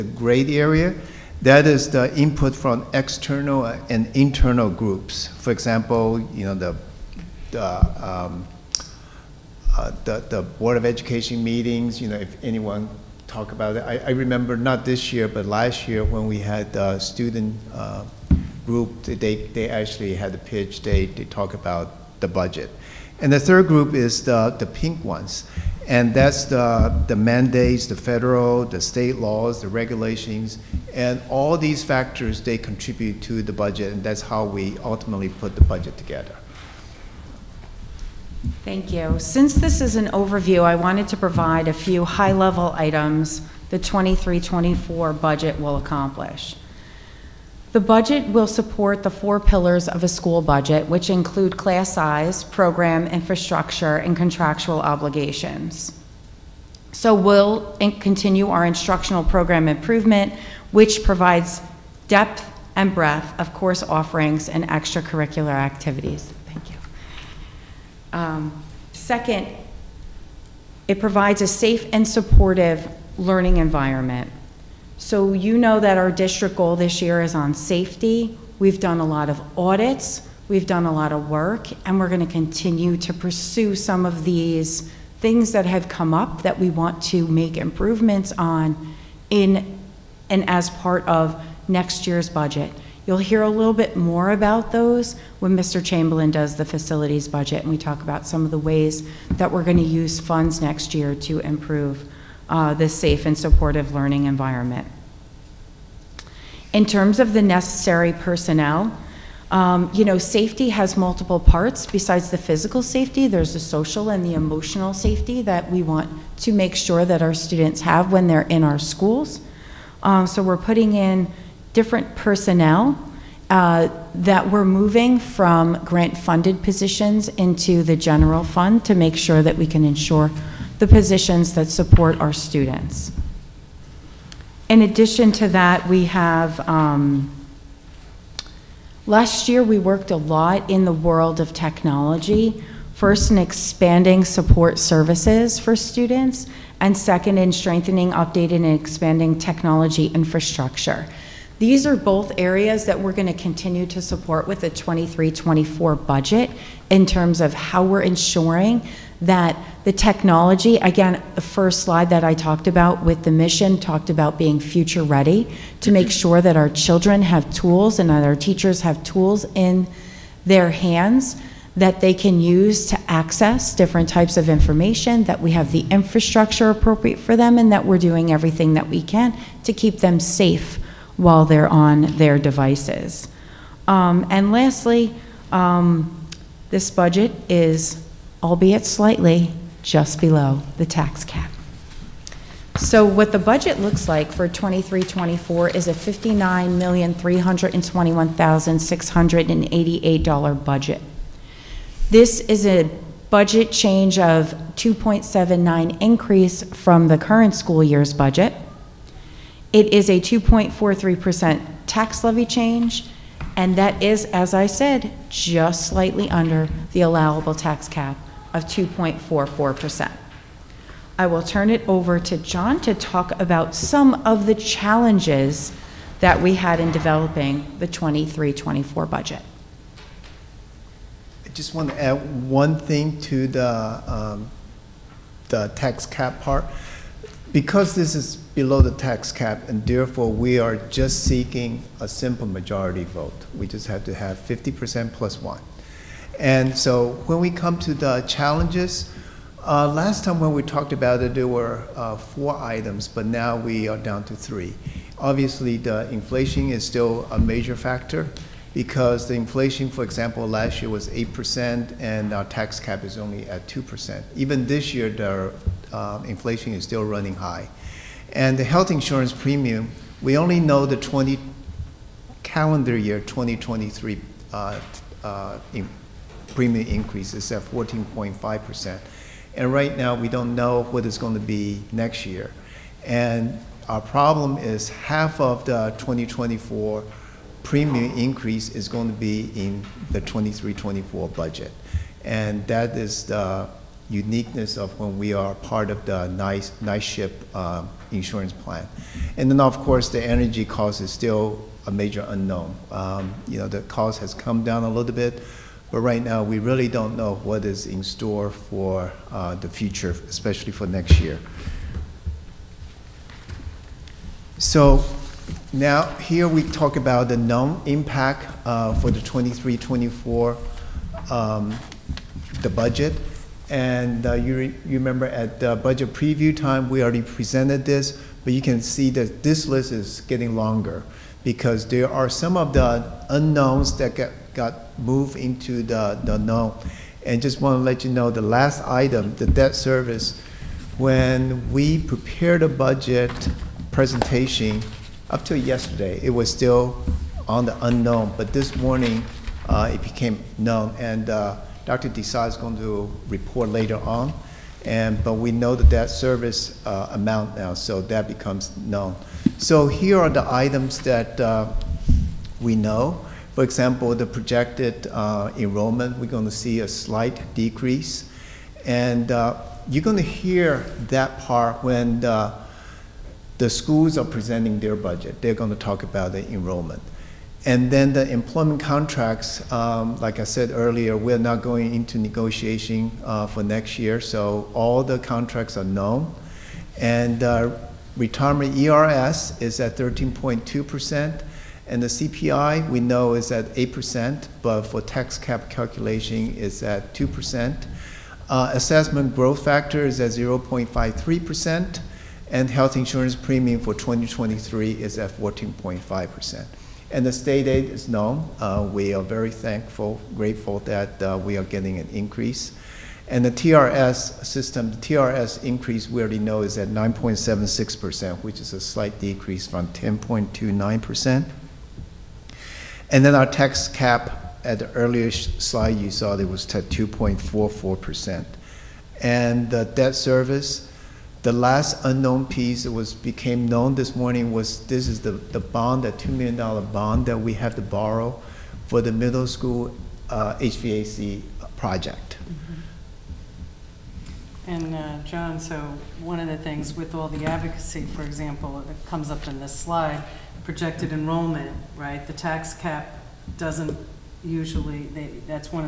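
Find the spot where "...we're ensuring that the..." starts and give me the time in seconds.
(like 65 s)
157 s.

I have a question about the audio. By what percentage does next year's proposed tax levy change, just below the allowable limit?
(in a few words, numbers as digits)
2.43%.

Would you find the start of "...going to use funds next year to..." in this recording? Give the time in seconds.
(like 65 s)
99 s.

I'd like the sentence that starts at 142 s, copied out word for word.
First in expanding support services for students, and second in strengthening, updating, and expanding technology infrastructure.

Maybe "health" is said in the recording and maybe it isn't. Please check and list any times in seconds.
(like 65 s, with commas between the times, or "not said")
268 s, 402 s.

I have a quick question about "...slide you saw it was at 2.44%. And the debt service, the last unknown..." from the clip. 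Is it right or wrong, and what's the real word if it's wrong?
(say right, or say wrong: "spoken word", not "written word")
right.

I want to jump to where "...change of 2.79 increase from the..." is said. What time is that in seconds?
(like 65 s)
203 s.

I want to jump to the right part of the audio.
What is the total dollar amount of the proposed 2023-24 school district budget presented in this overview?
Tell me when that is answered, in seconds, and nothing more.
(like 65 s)
195 s.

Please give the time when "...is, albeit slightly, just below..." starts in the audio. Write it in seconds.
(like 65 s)
187 s.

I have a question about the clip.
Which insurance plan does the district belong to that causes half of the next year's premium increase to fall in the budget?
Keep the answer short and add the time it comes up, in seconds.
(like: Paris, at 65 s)
NYSHIP, at 296 s.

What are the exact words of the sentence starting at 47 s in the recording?
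The budget will support the four pillars of a school budget, which include class size, program infrastructure, and contractual obligations.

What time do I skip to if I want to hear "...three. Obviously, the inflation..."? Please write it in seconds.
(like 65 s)
254 s.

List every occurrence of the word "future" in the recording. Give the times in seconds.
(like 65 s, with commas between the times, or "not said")
164 s, 309 s.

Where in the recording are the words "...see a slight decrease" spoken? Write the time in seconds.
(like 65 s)
366 s.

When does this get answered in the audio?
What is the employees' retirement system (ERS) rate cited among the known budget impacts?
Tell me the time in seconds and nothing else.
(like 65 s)
389 s.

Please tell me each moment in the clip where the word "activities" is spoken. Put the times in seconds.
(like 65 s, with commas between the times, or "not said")
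65 s.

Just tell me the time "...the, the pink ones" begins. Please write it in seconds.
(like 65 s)
24 s.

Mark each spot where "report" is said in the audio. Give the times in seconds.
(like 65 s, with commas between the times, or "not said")
353 s.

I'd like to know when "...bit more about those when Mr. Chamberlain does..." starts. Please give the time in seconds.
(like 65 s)
93 s.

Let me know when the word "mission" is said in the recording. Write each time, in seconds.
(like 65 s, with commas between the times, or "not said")
163 s.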